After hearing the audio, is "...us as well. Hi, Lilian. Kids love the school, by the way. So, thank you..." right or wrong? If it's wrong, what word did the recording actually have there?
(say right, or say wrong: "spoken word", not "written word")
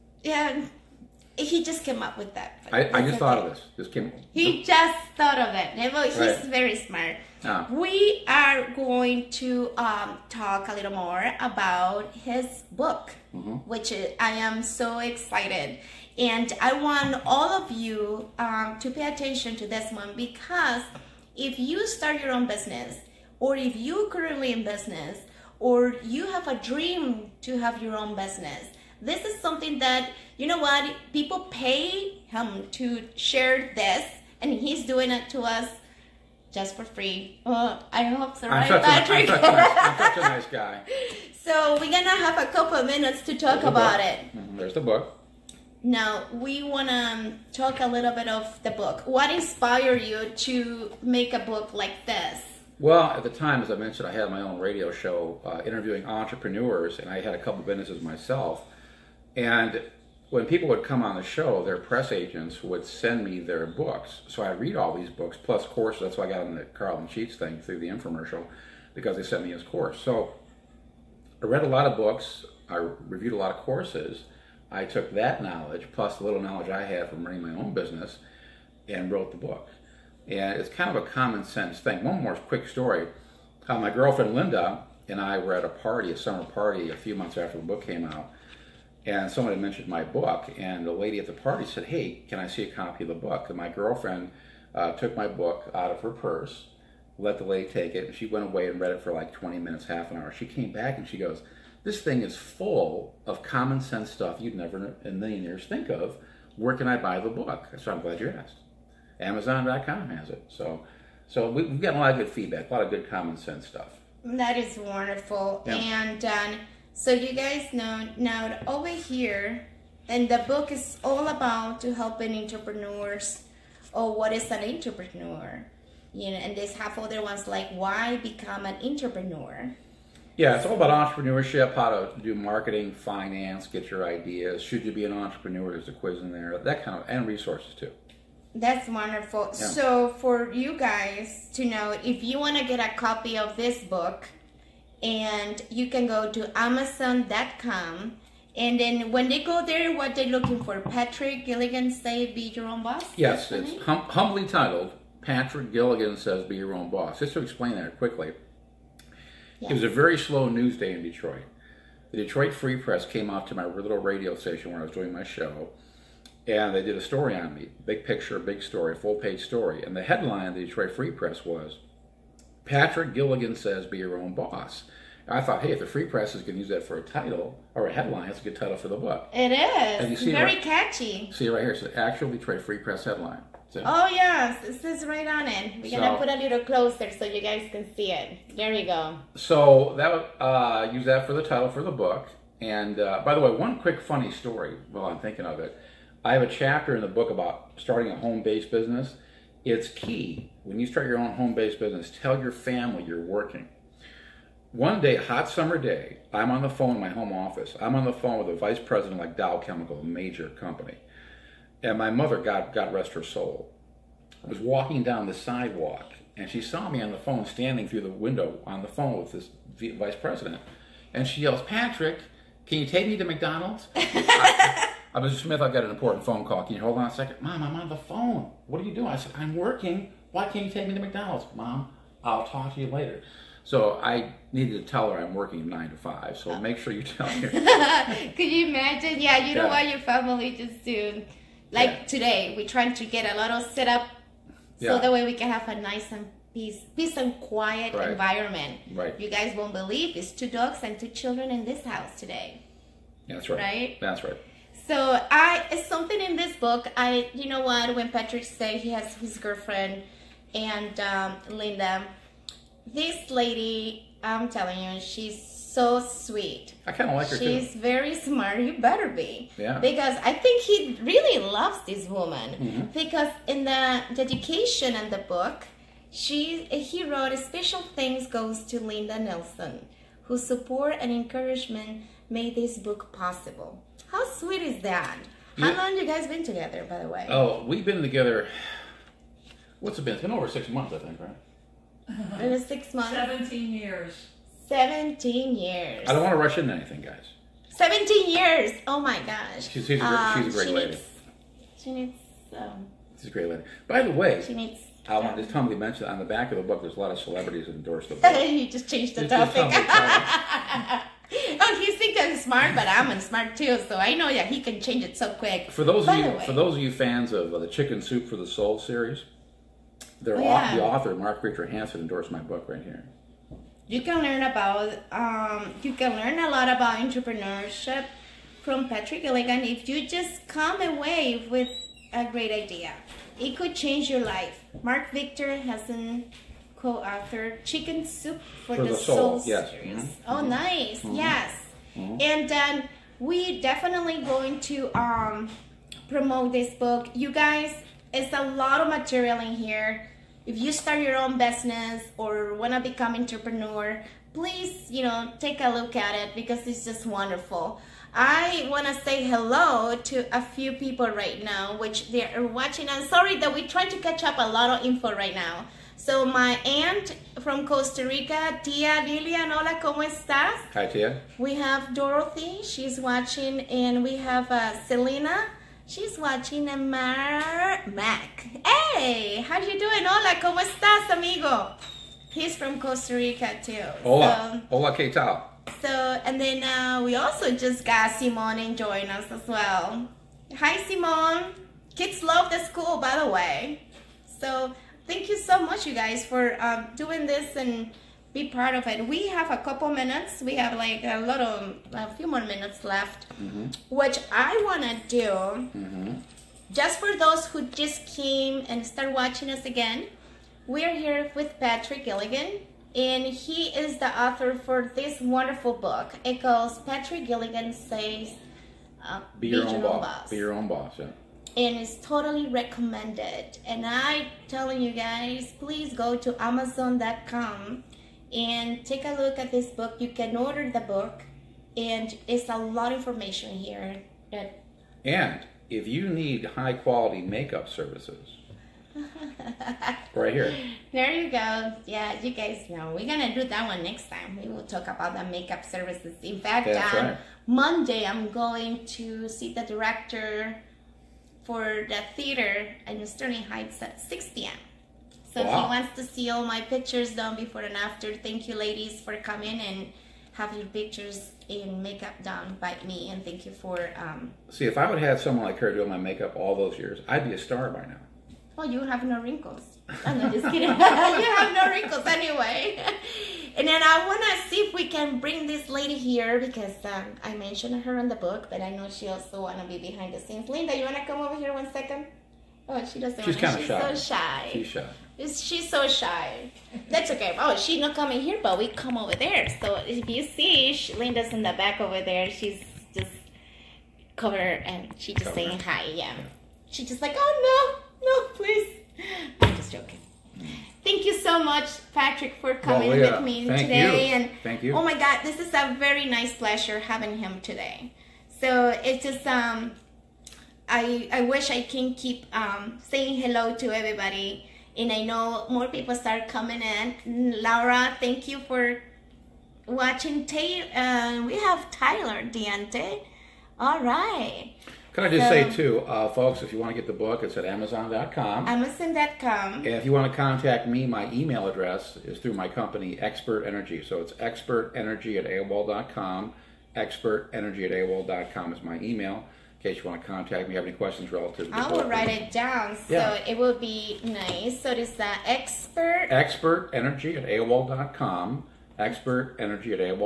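wrong: "Simone", not "Lilian".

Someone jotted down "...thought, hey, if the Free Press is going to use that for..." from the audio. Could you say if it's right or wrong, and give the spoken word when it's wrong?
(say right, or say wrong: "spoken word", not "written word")
right.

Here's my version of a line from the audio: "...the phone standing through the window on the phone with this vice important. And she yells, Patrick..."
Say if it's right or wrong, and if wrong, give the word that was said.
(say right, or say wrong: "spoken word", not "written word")
wrong: "president", not "important".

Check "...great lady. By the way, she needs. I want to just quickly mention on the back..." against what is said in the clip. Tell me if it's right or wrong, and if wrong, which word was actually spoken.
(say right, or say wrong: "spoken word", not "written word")
wrong: "humbly", not "quickly".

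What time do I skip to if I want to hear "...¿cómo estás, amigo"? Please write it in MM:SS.
06:20.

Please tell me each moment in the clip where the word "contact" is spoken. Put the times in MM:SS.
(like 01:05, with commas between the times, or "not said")
08:50, 09:00.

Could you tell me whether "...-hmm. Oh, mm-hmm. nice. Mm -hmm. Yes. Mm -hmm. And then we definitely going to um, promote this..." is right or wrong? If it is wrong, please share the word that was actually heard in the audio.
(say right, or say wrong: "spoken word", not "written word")
right.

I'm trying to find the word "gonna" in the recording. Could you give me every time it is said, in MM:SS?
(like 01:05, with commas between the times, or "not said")
00:41, 03:05.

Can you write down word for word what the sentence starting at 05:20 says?
the author Mark Richard Hansen endorsed my book right here.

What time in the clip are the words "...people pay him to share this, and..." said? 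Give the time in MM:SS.
00:31.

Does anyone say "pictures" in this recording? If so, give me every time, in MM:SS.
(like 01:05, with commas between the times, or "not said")
02:48, 07:36, 07:40.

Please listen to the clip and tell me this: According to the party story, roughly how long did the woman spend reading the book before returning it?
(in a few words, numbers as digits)
20 minutes.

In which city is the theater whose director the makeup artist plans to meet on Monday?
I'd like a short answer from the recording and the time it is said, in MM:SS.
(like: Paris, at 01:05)
Sterling Heights, at 07:33.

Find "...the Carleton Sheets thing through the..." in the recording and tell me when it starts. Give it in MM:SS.
01:06.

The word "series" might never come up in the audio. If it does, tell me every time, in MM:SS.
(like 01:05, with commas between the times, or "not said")
05:18, 05:39.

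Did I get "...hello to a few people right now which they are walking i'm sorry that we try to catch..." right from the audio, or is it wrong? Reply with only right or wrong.
wrong.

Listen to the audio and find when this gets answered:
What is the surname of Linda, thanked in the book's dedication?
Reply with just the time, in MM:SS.
04:39.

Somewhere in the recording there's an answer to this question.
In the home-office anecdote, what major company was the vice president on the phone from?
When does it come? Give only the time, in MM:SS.
03:29.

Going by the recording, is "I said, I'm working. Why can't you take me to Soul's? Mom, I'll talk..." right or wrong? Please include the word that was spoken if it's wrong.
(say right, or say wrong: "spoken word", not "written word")
wrong: "McDonald", not "Soul".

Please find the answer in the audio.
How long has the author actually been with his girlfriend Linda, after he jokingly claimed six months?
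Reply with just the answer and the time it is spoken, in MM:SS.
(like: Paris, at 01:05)
17 years, at 04:53.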